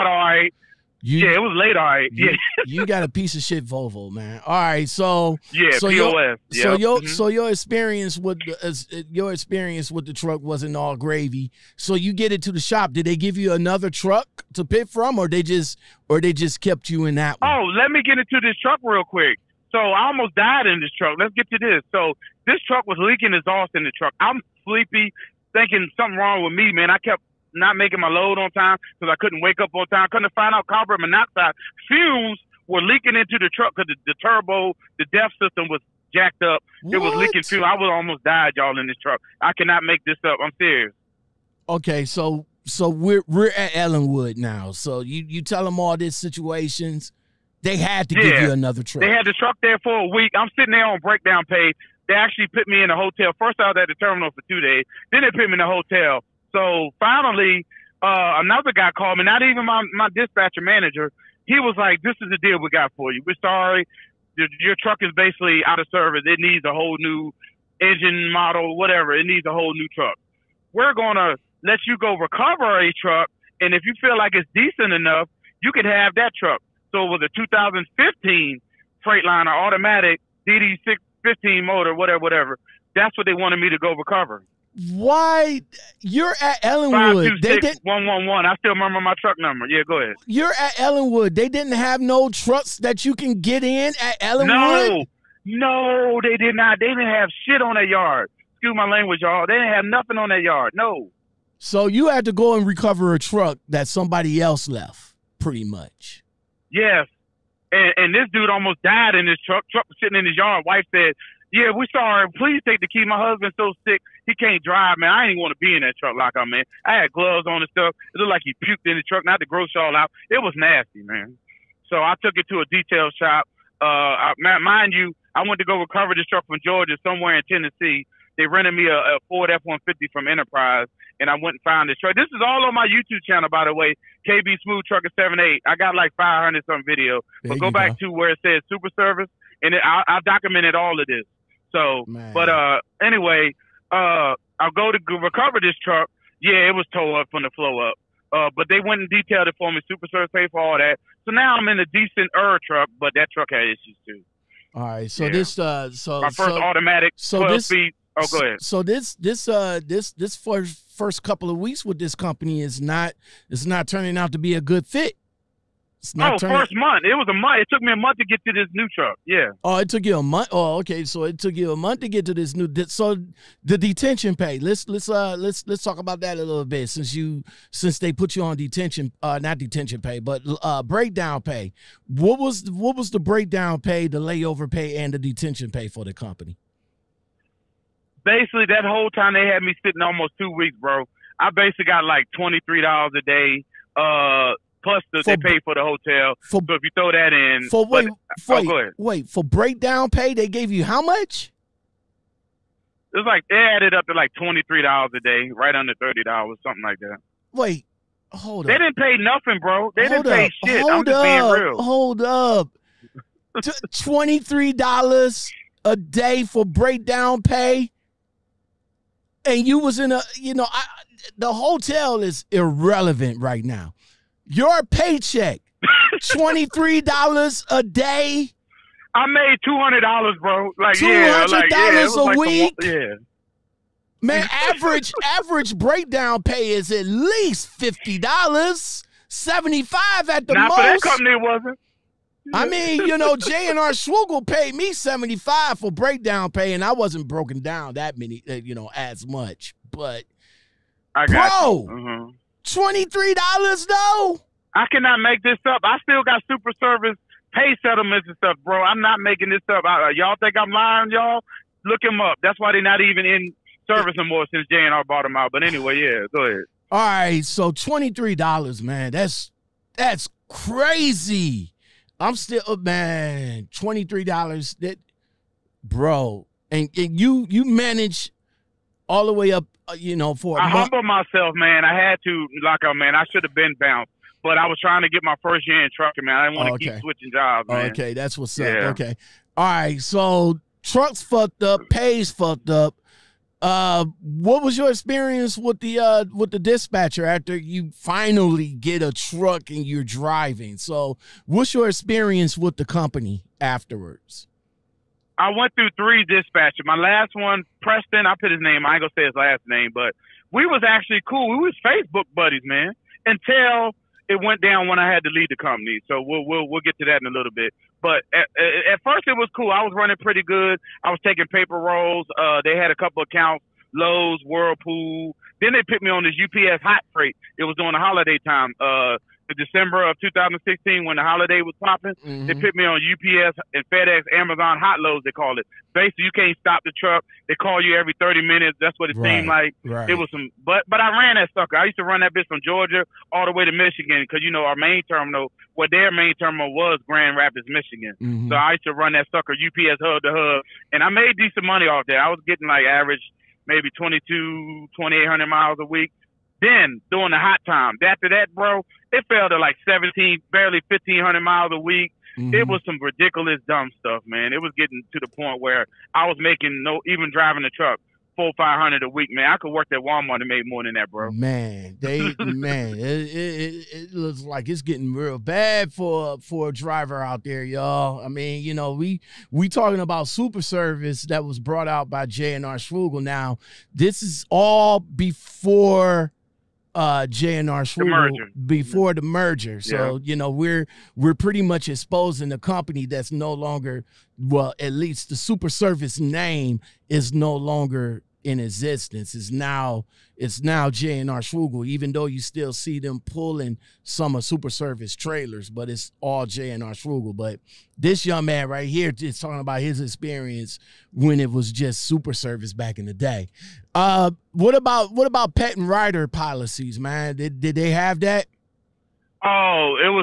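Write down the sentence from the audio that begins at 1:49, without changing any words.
Truck was sitting in his yard.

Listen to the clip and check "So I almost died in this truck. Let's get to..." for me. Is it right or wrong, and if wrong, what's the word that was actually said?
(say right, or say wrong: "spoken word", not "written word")
right.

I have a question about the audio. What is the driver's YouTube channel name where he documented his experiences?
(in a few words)
KB Smooth Trucker 78.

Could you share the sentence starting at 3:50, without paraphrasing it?
Like, $200 yeah, like, yeah, a like week?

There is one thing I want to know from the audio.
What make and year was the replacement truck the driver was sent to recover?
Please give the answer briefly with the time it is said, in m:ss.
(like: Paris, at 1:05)
2015 Freightliner, at 1:17.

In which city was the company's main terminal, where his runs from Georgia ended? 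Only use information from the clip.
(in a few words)
Grand Rapids, Michigan.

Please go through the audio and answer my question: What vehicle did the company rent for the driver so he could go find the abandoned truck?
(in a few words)
Ford F-150.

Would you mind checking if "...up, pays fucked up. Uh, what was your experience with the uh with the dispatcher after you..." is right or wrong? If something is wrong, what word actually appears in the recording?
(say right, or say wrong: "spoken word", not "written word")
right.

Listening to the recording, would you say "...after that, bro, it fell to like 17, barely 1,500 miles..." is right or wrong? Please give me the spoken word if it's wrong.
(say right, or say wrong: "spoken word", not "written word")
right.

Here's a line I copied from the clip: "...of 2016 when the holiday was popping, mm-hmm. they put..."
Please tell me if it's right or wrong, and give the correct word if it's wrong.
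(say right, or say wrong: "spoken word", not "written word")
right.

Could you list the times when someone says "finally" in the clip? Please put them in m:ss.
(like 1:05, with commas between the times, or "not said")
0:57, 4:57.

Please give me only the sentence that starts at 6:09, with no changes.
I could work at Walmart and make more than that, bro.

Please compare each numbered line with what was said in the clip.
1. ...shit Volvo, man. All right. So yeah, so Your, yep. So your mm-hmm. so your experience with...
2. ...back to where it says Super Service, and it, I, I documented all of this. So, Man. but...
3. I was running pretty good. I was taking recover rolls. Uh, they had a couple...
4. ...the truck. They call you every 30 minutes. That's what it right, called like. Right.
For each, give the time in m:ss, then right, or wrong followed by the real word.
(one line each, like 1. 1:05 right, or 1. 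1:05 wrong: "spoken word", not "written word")
1. 0:03 right
2. 2:17 right
3. 5:19 wrong: "paper", not "recover"
4. 5:36 wrong: "seemed", not "called".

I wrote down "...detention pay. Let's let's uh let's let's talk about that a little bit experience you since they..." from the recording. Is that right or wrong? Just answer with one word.
wrong.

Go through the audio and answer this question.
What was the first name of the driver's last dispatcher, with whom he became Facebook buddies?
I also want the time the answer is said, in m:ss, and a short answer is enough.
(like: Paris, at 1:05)
Preston, at 5:07.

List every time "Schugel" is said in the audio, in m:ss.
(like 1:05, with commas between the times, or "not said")
4:03, 6:22, 6:41, 6:46.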